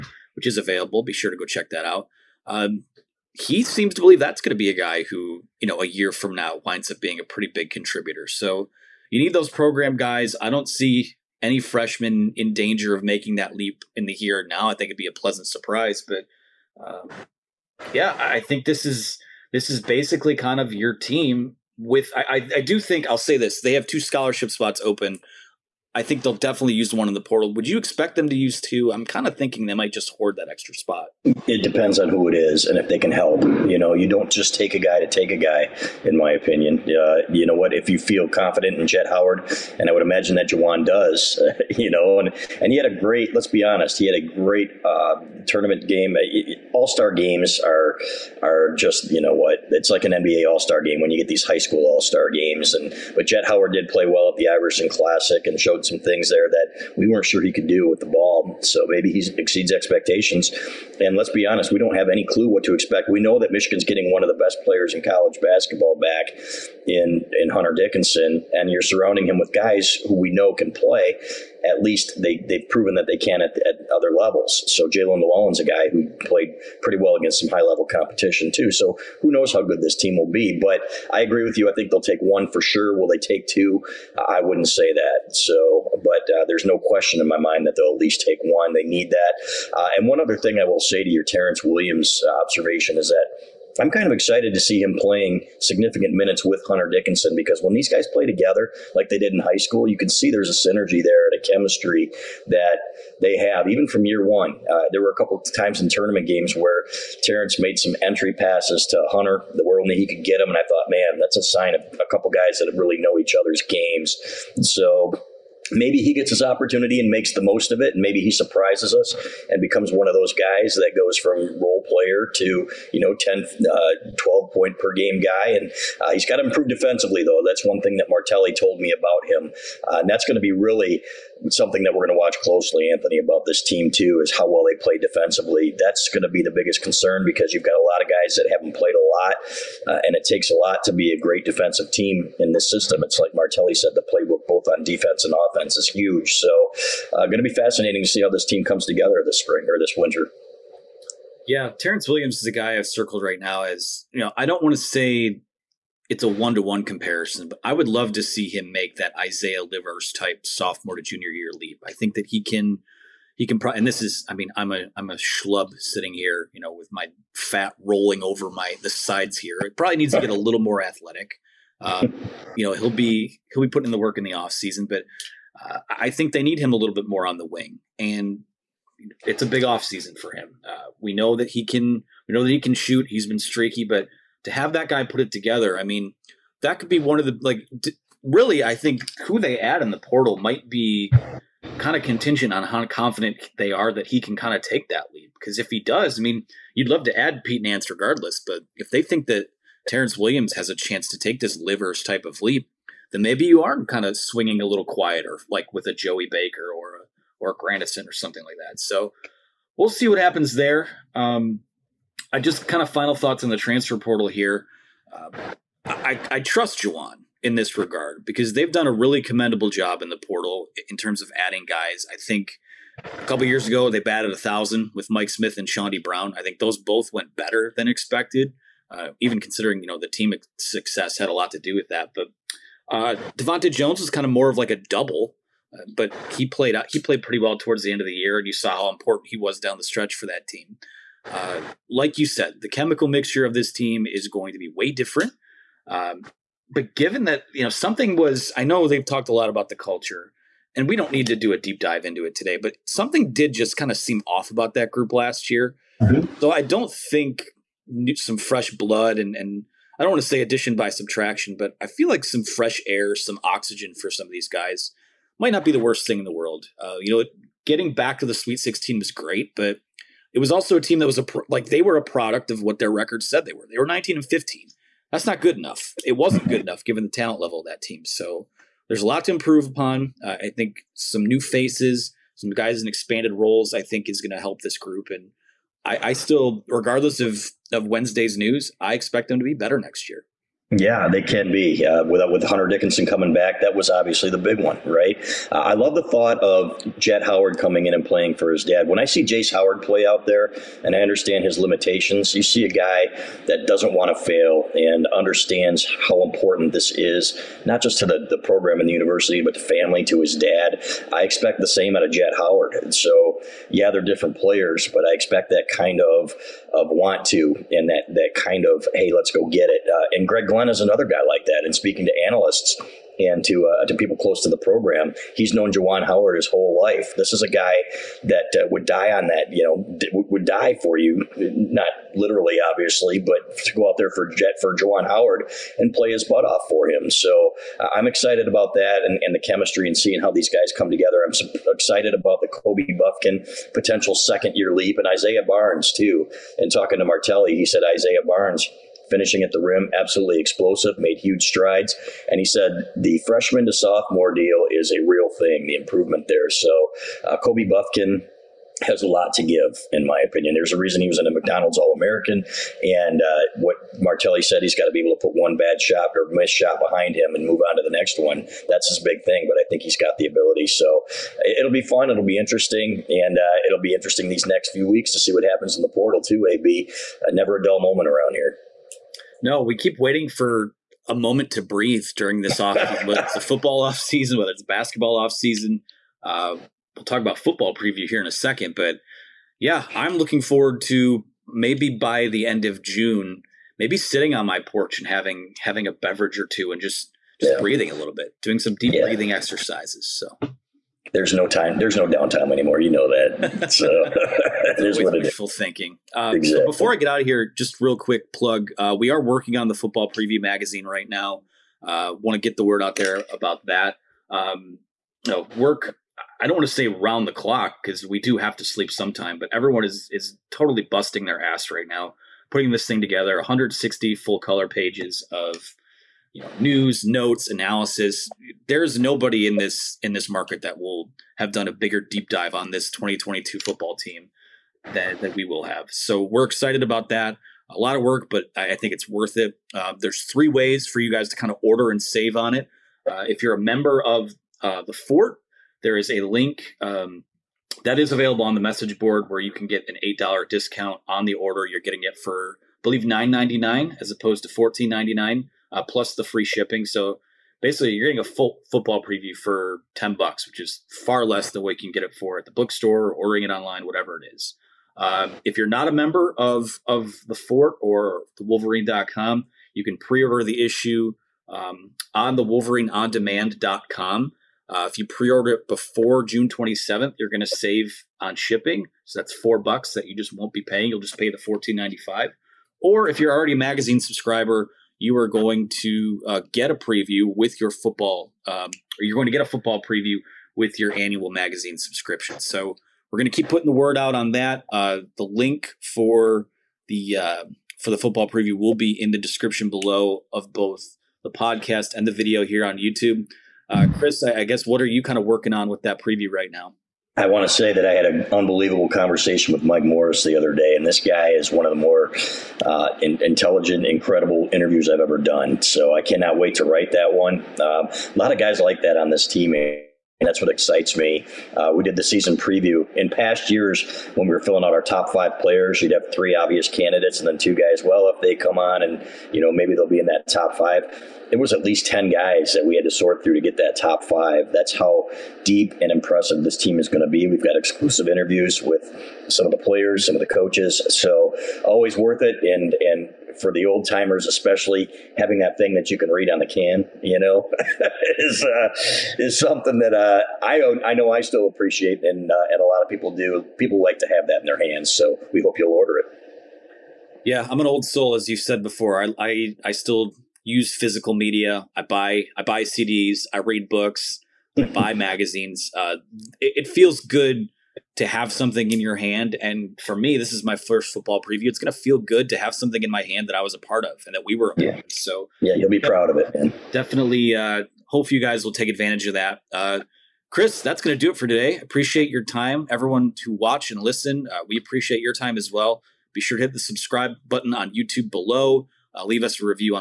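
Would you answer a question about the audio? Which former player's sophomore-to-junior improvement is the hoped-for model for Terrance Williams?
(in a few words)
Isaiah Livers.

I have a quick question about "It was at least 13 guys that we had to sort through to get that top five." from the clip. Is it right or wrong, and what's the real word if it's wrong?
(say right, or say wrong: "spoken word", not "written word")
wrong: "10", not "13".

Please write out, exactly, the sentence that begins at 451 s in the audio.
You're getting it for I believe nine ninety nine as opposed to fourteen ninety nine uh, plus the free shipping.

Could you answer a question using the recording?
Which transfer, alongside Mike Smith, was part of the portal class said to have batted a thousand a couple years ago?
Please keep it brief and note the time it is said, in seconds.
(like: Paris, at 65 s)
Chaundee Brown, at 225 s.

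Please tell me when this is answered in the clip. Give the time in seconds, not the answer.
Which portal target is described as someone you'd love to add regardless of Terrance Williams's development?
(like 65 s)
197 s.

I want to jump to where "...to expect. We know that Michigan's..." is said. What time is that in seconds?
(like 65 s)
62 s.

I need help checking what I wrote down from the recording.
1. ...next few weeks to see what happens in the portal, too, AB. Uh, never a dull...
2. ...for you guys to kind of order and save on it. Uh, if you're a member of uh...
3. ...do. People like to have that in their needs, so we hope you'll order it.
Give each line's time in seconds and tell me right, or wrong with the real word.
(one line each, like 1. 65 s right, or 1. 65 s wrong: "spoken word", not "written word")
1. 374 s right
2. 440 s right
3. 553 s wrong: "hands", not "needs".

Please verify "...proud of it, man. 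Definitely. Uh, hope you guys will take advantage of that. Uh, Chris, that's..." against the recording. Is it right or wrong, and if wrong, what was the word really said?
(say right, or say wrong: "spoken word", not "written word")
right.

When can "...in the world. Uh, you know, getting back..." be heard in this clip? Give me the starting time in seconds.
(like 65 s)
266 s.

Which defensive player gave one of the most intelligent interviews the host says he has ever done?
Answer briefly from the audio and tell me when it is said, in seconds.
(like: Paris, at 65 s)
Mike Morris, at 509 s.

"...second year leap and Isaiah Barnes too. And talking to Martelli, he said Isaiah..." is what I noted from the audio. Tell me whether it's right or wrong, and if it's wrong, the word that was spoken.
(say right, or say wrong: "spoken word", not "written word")
right.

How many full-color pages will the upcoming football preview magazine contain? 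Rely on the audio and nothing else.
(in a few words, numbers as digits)
160.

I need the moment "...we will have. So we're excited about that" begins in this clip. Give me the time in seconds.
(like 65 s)
435 s.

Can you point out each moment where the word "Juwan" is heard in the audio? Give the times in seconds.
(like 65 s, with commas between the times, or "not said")
40 s, 216 s, 325 s, 334 s.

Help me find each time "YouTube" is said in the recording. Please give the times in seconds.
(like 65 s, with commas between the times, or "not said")
502 s, 587 s.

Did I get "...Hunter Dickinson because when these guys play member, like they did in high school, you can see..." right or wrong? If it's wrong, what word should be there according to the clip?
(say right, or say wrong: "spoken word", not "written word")
wrong: "together", not "member".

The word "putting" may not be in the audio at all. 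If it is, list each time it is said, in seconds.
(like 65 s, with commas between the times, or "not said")
173 s, 422 s, 493 s.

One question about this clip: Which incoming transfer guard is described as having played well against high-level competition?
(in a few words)
Jaelin Llewellyn.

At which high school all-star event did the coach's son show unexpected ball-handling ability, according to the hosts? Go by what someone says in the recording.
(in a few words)
Iverson Classic.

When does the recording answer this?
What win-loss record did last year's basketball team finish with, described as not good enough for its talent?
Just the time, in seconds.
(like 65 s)
273 s.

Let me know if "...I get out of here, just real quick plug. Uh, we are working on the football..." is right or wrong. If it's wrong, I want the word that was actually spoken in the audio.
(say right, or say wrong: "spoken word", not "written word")
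right.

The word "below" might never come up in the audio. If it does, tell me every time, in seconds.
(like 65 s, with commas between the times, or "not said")
499 s, 588 s.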